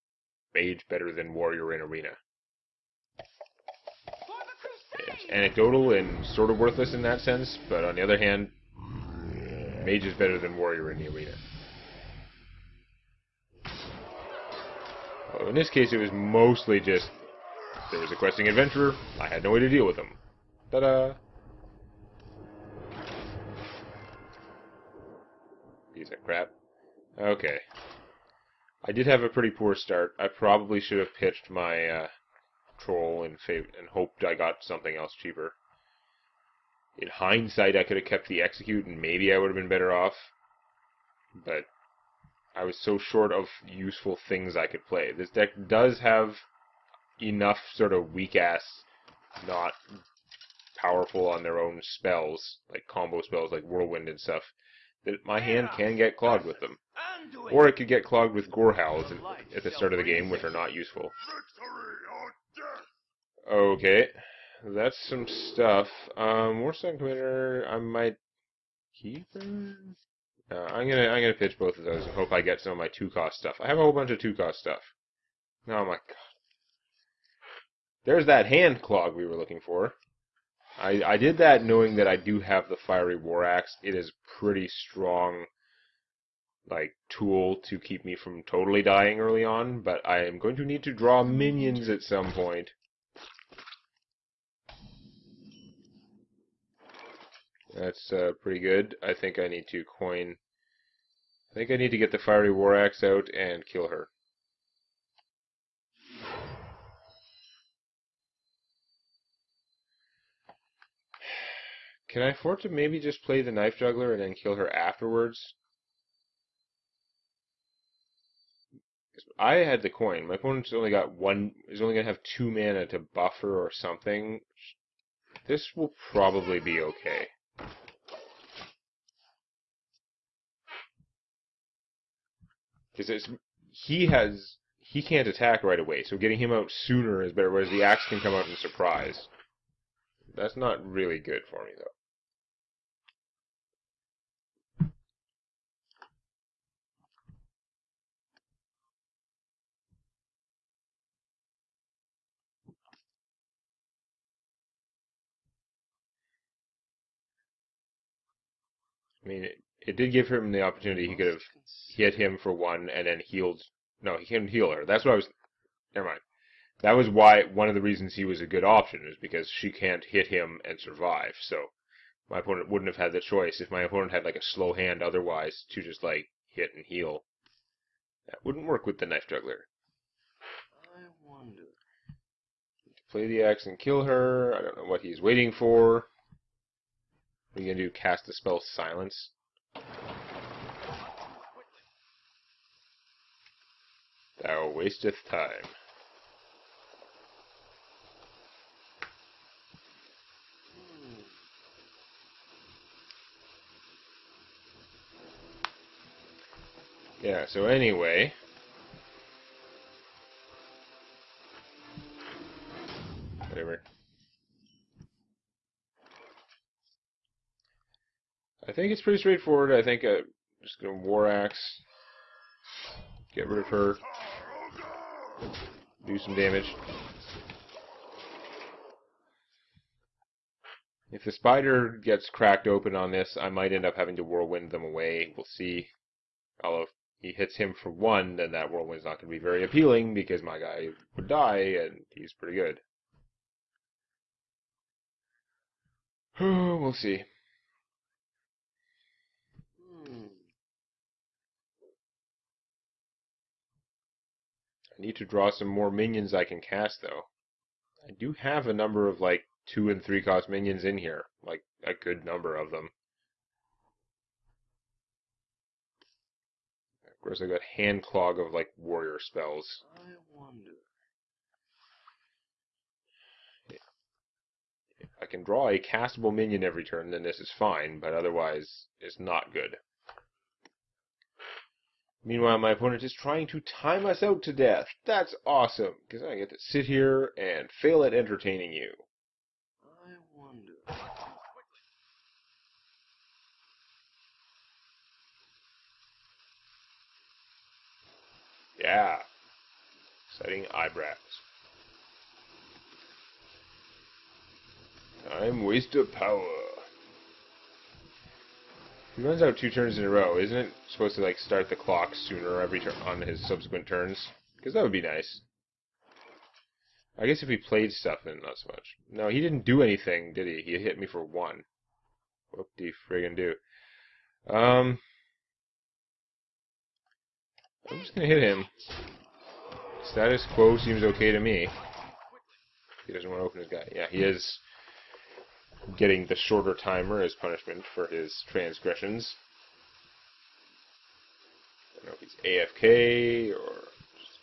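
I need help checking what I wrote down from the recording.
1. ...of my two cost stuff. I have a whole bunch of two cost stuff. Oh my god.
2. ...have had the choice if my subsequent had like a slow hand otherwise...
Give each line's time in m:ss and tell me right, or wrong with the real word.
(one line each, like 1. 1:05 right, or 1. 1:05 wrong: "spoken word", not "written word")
1. 1:12 right
2. 2:52 wrong: "opponent", not "subsequent".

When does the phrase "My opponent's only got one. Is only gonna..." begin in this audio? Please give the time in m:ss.
2:00.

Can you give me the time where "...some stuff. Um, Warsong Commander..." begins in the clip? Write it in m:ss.
1:05.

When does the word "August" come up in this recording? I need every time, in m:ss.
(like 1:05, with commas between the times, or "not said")
not said.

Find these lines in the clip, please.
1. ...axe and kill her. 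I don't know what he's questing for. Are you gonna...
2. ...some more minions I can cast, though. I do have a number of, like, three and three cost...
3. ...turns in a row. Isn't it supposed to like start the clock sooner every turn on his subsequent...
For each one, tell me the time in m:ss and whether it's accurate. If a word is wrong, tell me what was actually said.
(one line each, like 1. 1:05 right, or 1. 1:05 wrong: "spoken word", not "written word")
1. 3:03 wrong: "waiting", not "questing"
2. 4:15 wrong: "two", not "three"
3. 5:09 right.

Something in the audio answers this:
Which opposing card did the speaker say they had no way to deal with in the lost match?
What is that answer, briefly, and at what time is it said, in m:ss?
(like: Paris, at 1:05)
Questing adventurer, at 0:18.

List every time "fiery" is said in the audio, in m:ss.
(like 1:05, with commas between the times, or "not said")
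1:22, 1:42.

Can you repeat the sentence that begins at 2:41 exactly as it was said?
He could have hit him for one and then healed.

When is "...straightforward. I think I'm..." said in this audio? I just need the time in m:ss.
3:39.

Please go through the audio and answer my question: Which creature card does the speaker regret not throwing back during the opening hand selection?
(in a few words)
Troll.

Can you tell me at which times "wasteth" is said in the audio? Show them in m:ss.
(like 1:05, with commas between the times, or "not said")
3:14.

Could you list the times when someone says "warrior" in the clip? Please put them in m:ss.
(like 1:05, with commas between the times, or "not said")
0:01, 0:10, 4:28.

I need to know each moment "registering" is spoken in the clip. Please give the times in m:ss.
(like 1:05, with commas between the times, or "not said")
not said.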